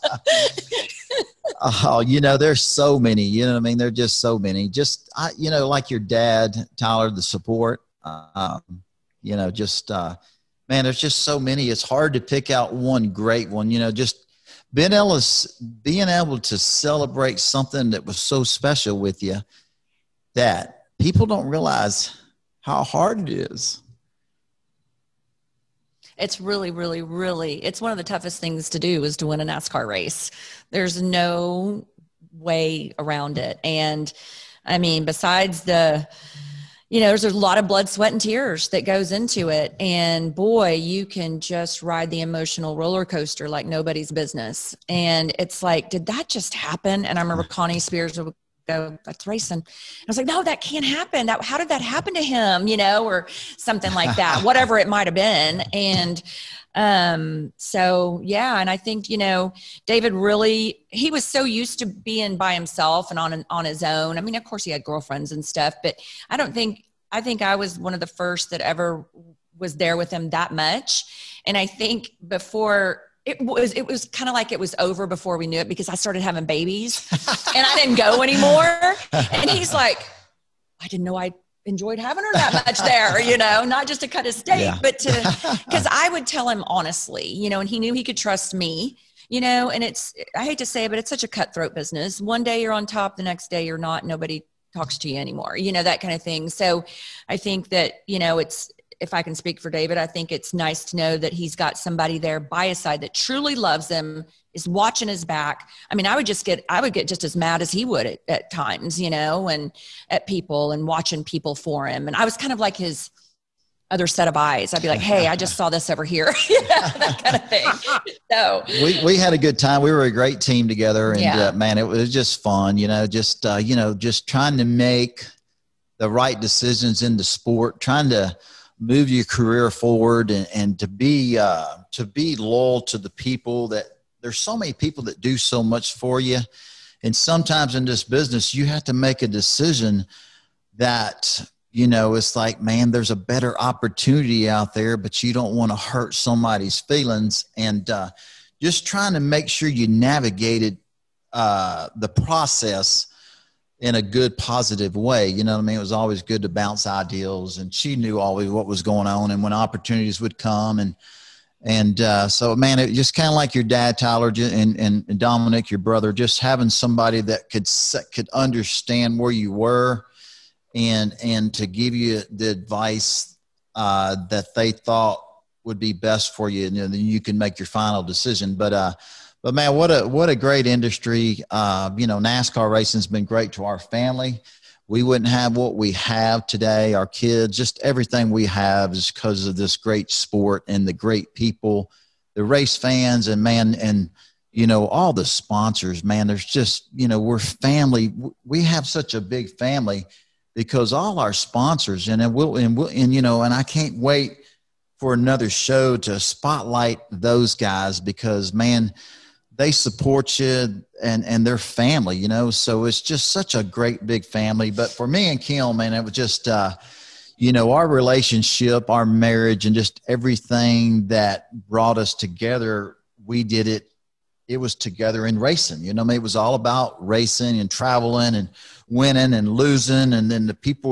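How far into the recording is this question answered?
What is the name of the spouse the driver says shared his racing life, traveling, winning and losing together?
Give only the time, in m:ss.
3:35.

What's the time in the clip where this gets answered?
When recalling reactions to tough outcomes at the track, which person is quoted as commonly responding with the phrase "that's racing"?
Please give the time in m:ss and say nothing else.
0:47.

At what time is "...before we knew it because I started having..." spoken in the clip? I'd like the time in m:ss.
1:15.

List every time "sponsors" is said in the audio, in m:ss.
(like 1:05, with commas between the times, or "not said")
3:15, 3:21.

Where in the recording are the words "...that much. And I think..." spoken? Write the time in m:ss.
1:10.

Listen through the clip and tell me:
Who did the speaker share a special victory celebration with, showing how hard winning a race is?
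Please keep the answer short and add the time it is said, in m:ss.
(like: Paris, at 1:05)
Ben Ellis, at 0:14.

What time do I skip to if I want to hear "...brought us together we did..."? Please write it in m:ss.
3:41.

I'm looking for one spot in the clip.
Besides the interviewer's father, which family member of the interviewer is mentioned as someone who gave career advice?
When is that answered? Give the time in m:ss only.
2:45.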